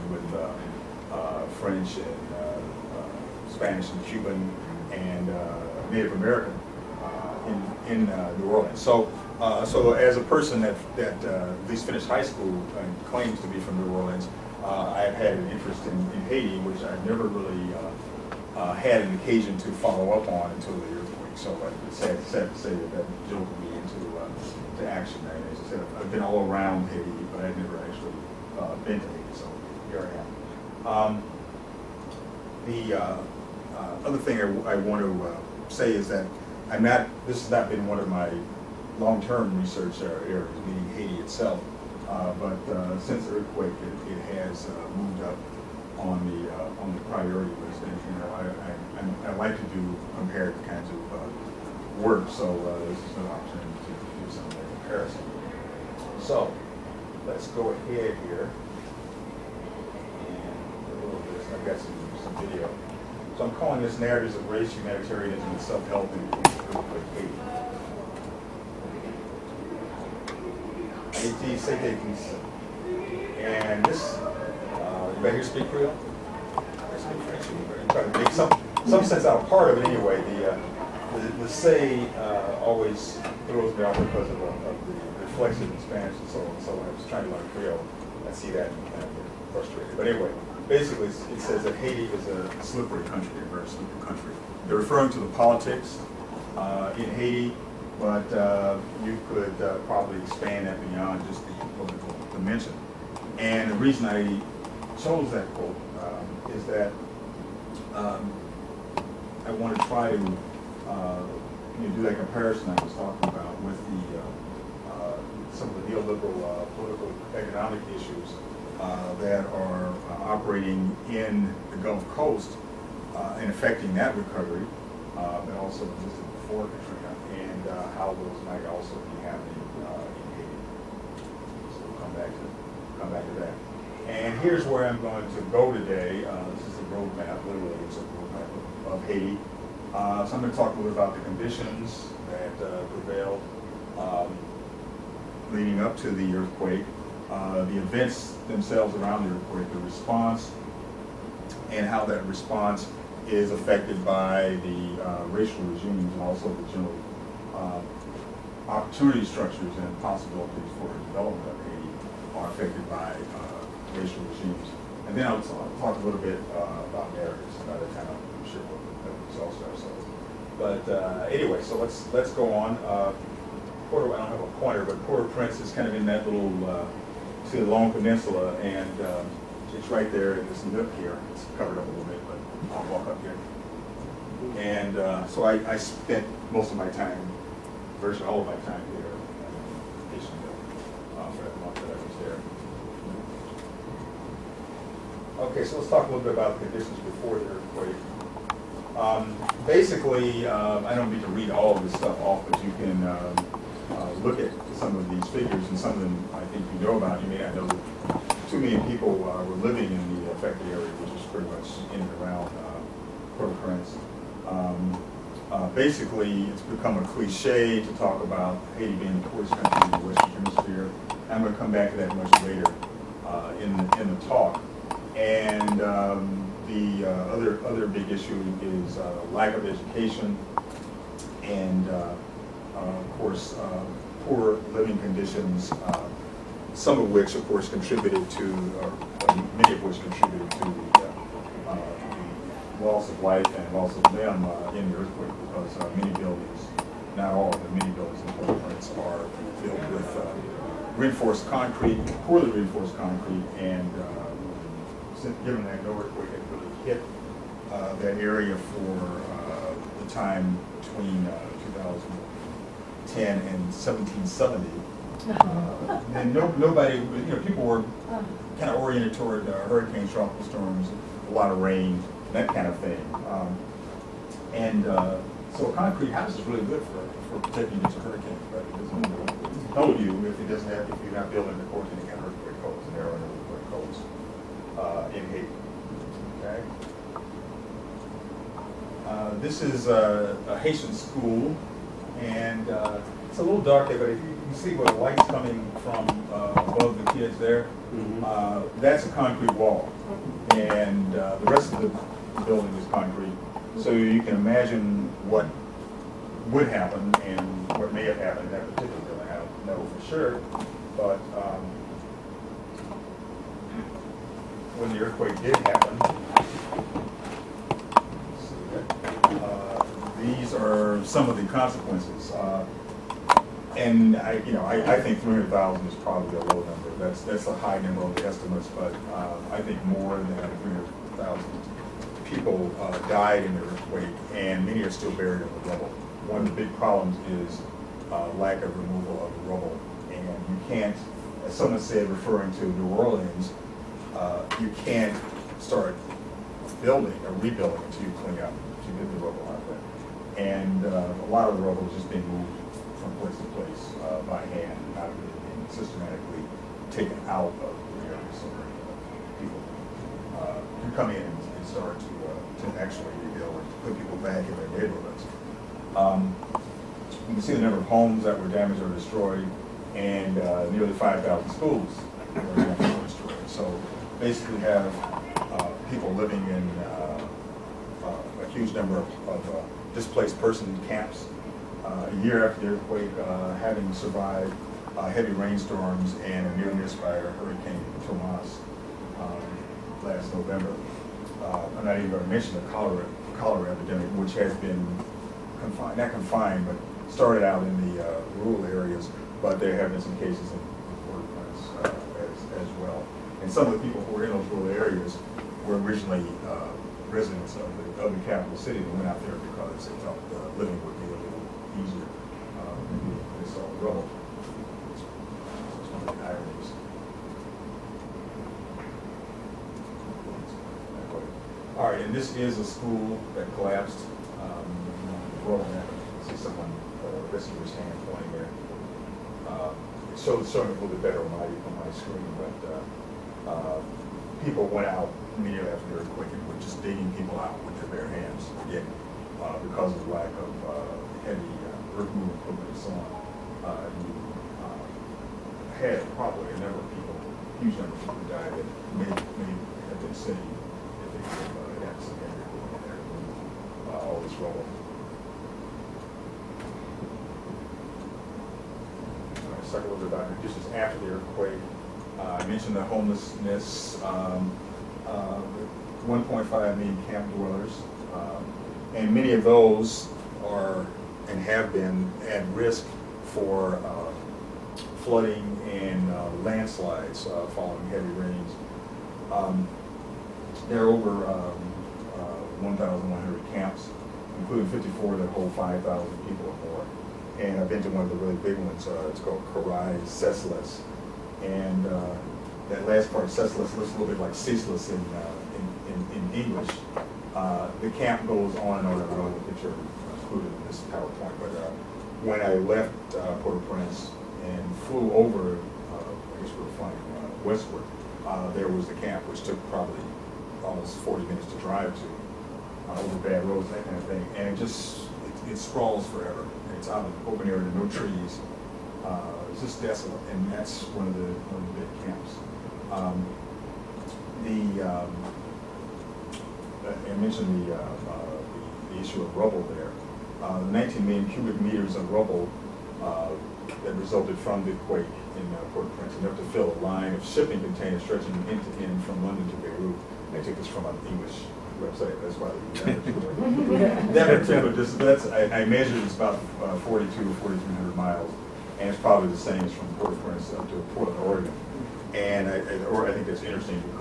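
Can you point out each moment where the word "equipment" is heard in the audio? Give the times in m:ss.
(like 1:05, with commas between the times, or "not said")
7:22.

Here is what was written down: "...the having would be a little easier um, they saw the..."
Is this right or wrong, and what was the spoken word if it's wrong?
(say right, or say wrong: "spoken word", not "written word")
wrong: "living", not "having".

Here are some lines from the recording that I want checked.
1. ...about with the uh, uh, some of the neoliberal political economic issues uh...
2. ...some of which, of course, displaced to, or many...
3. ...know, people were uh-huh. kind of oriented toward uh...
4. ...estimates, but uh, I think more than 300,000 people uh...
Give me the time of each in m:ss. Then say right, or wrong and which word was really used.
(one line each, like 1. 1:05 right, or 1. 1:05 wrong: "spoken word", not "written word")
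1. 1:53 right
2. 3:56 wrong: "contributed", not "displaced"
3. 4:27 right
4. 5:28 right.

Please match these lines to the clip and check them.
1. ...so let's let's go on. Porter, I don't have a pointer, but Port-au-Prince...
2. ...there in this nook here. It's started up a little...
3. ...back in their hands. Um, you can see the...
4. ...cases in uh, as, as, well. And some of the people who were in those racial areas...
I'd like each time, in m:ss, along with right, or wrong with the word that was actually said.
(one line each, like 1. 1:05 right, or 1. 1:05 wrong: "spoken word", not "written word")
1. 2:51 right
2. 3:00 wrong: "covered", not "started"
3. 6:04 wrong: "neighborhoods", not "hands"
4. 6:40 wrong: "rural", not "racial".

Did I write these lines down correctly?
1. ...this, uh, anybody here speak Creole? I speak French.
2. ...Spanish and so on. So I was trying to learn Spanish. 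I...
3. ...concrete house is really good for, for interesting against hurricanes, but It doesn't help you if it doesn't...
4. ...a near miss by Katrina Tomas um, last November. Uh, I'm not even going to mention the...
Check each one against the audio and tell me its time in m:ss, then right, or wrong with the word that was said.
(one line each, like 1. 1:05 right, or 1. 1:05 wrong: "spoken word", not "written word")
1. 1:13 right
2. 1:25 wrong: "Creole", not "Spanish"
3. 4:35 wrong: "protecting", not "interesting"
4. 6:26 wrong: "Hurricane", not "Katrina".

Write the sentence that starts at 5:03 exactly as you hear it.
So you can imagine what would happen and what may have happened in that particular building.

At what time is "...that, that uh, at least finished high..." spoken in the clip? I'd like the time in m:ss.
0:10.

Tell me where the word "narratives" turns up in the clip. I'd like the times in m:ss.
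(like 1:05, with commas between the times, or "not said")
1:03, 2:47.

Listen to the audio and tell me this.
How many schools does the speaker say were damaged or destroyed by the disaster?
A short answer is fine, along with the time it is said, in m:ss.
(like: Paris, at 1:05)
nearly 5,000, at 6:10.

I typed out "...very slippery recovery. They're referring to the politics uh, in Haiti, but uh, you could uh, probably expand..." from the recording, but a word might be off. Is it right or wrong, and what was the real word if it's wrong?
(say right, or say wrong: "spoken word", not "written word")
wrong: "country", not "recovery".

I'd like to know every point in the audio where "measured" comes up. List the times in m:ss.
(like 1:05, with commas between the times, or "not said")
9:05.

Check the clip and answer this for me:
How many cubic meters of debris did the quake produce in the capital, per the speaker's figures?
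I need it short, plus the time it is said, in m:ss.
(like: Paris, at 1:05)
19 million, at 8:50.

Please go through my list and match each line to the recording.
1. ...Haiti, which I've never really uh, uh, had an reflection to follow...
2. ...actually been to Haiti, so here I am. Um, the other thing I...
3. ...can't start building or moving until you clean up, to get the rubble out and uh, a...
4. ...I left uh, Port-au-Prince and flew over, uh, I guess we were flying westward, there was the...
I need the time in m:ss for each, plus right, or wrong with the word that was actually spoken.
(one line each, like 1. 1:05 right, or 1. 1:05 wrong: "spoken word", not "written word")
1. 0:16 wrong: "occasion", not "reflection"
2. 0:27 right
3. 5:44 wrong: "rebuilding", not "moving"
4. 8:22 right.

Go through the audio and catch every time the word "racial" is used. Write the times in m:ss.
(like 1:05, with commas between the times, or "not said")
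2:35, 2:43.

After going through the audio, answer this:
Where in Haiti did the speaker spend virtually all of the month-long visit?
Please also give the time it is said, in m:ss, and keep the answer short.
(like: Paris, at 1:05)
Pétion-Ville, at 3:10.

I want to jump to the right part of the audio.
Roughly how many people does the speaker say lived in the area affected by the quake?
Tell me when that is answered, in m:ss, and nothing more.
3:28.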